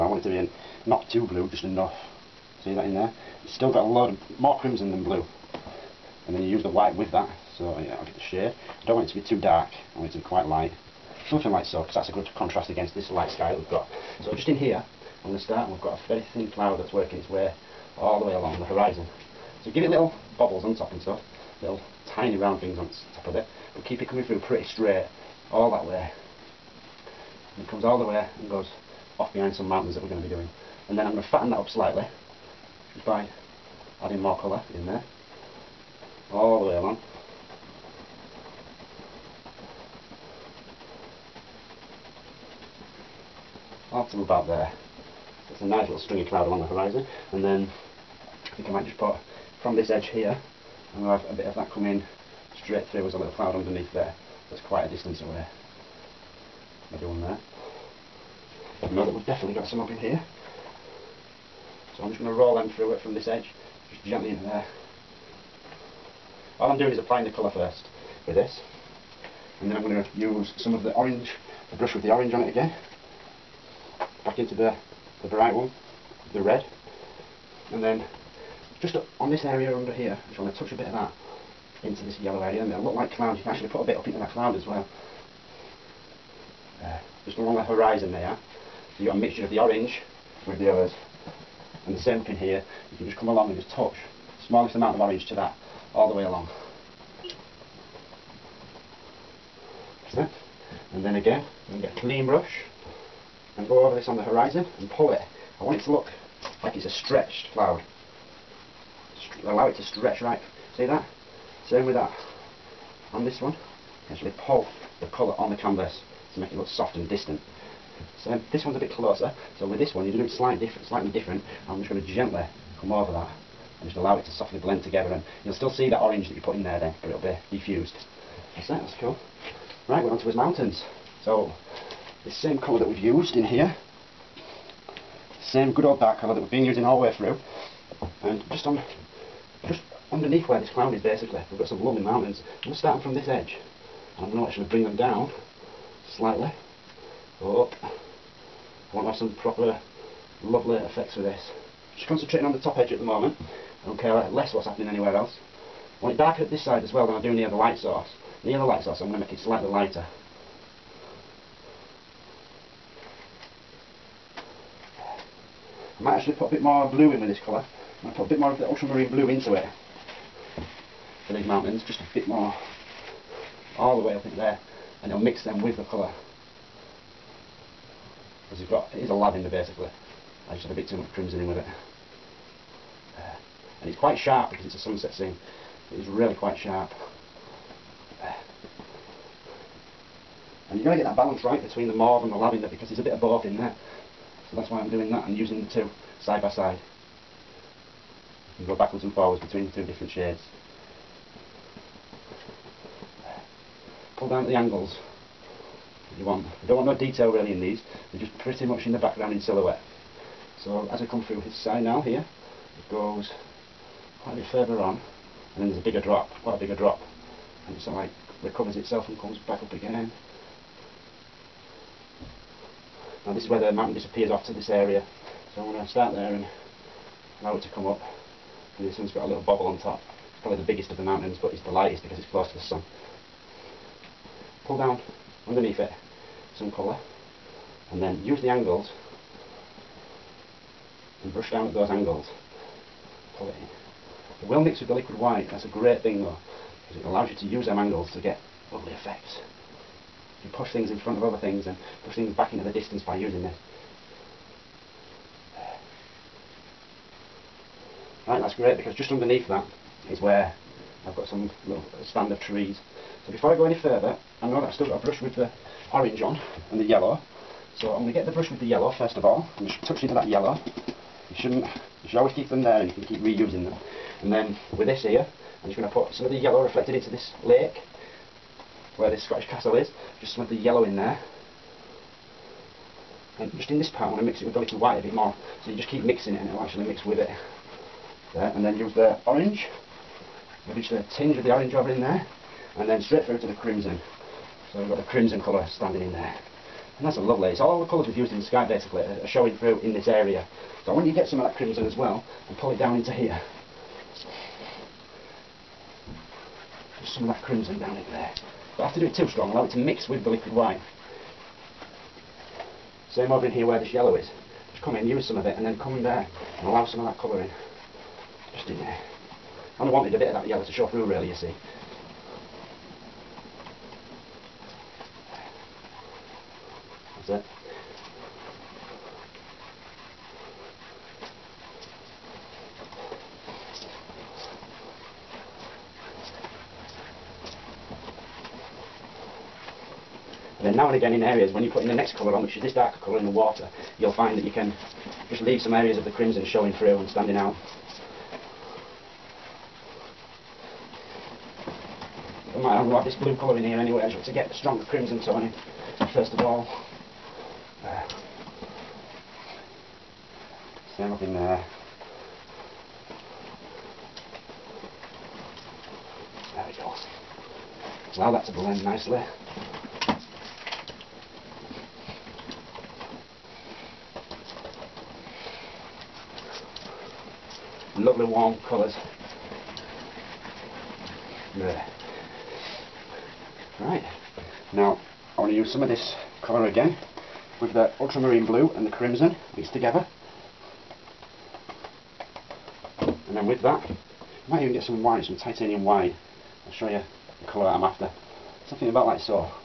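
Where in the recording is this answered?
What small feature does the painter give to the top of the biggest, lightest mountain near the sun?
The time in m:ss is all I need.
3:49.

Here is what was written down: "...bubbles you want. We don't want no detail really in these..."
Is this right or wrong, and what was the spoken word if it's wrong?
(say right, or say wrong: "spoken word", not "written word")
wrong: "angles", not "bubbles".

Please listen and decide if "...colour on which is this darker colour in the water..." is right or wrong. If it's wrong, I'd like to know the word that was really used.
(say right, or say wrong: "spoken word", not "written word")
right.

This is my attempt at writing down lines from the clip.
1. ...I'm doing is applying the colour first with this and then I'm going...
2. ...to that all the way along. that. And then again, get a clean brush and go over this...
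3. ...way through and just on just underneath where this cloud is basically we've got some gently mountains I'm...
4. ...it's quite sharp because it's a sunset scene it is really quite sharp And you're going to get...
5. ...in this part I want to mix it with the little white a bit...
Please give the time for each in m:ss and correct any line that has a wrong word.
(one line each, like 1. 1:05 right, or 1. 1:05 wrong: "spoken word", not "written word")
1. 1:06 right
2. 1:35 right
3. 2:17 wrong: "lovely", not "gently"
4. 3:03 right
5. 4:43 right.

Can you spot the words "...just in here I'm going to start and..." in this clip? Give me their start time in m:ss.
0:14.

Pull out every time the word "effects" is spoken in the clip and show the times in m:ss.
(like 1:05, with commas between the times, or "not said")
2:30, 4:08.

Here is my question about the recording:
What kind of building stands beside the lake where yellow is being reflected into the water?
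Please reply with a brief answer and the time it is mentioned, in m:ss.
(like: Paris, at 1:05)
Scottish castle, at 4:39.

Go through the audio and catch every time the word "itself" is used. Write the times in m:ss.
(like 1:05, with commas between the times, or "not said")
3:38.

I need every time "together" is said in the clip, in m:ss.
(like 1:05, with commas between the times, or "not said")
2:04, 6:29.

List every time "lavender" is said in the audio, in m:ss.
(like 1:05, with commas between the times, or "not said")
2:59, 3:12.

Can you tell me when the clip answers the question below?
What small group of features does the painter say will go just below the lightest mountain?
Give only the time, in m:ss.
4:22.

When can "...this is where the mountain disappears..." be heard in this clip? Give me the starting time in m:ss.
3:43.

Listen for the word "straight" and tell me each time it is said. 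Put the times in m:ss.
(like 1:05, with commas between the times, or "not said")
0:24, 0:52, 4:53.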